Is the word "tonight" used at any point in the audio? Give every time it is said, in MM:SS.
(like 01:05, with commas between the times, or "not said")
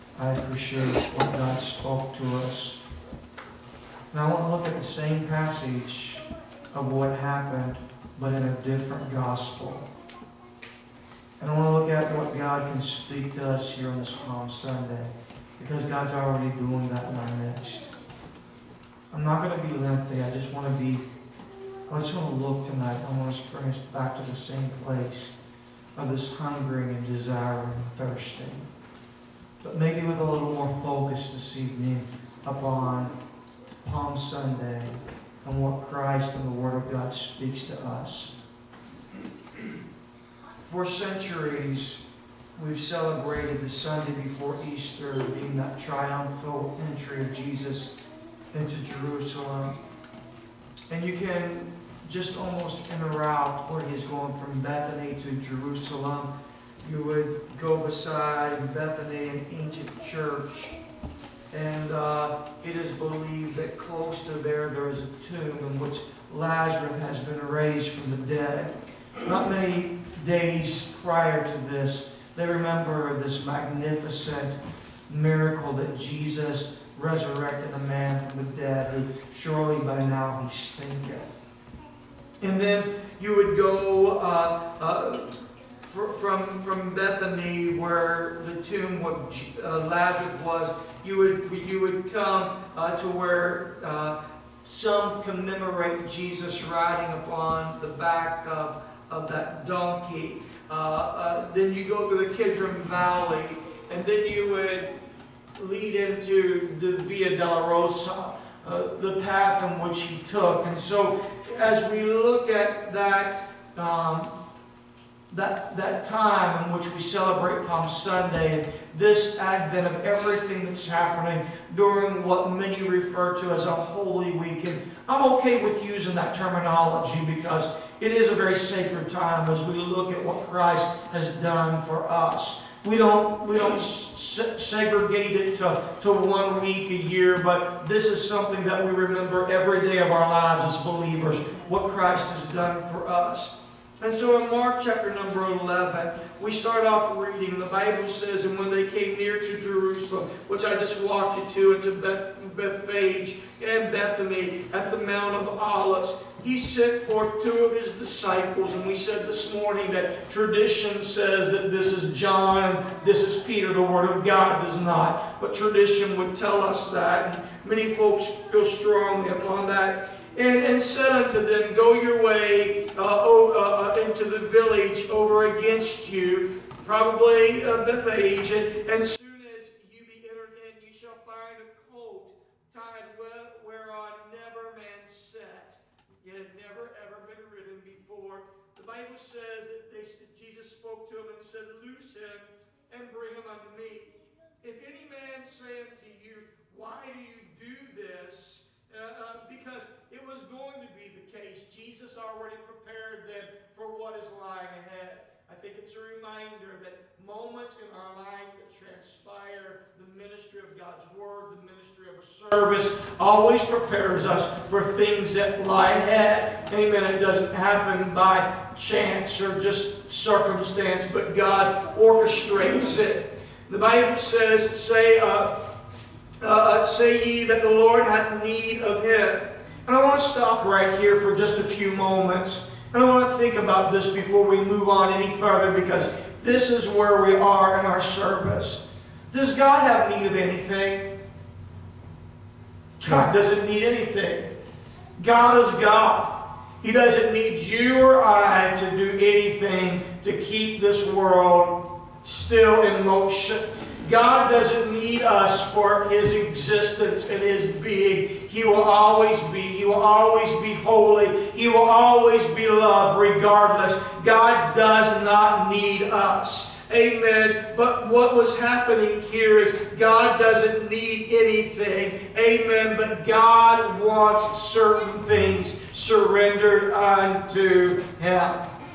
00:22.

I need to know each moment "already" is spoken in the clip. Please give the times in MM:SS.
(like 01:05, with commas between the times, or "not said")
00:16, 03:22.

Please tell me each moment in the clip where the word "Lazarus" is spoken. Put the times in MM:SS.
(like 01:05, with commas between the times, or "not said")
01:06, 01:29.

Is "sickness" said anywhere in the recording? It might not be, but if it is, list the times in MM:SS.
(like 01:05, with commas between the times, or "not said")
not said.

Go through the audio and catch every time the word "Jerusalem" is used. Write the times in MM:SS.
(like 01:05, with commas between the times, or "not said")
00:48, 00:55, 02:29.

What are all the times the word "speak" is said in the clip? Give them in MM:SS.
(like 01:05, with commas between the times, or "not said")
00:12, 00:37.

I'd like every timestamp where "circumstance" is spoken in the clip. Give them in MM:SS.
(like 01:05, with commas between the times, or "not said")
03:40.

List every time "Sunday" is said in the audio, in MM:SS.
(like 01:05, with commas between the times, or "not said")
00:14, 00:34, 00:43, 01:57.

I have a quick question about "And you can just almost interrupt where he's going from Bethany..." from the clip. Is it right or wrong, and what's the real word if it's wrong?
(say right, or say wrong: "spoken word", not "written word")
right.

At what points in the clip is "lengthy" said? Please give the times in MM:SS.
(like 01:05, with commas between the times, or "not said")
00:19.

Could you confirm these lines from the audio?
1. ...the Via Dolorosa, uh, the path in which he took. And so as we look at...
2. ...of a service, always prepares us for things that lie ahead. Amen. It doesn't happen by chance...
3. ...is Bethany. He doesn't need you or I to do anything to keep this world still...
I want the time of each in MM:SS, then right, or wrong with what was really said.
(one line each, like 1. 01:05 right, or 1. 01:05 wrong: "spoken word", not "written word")
1. 01:46 right
2. 03:32 right
3. 04:05 wrong: "God", not "Bethany".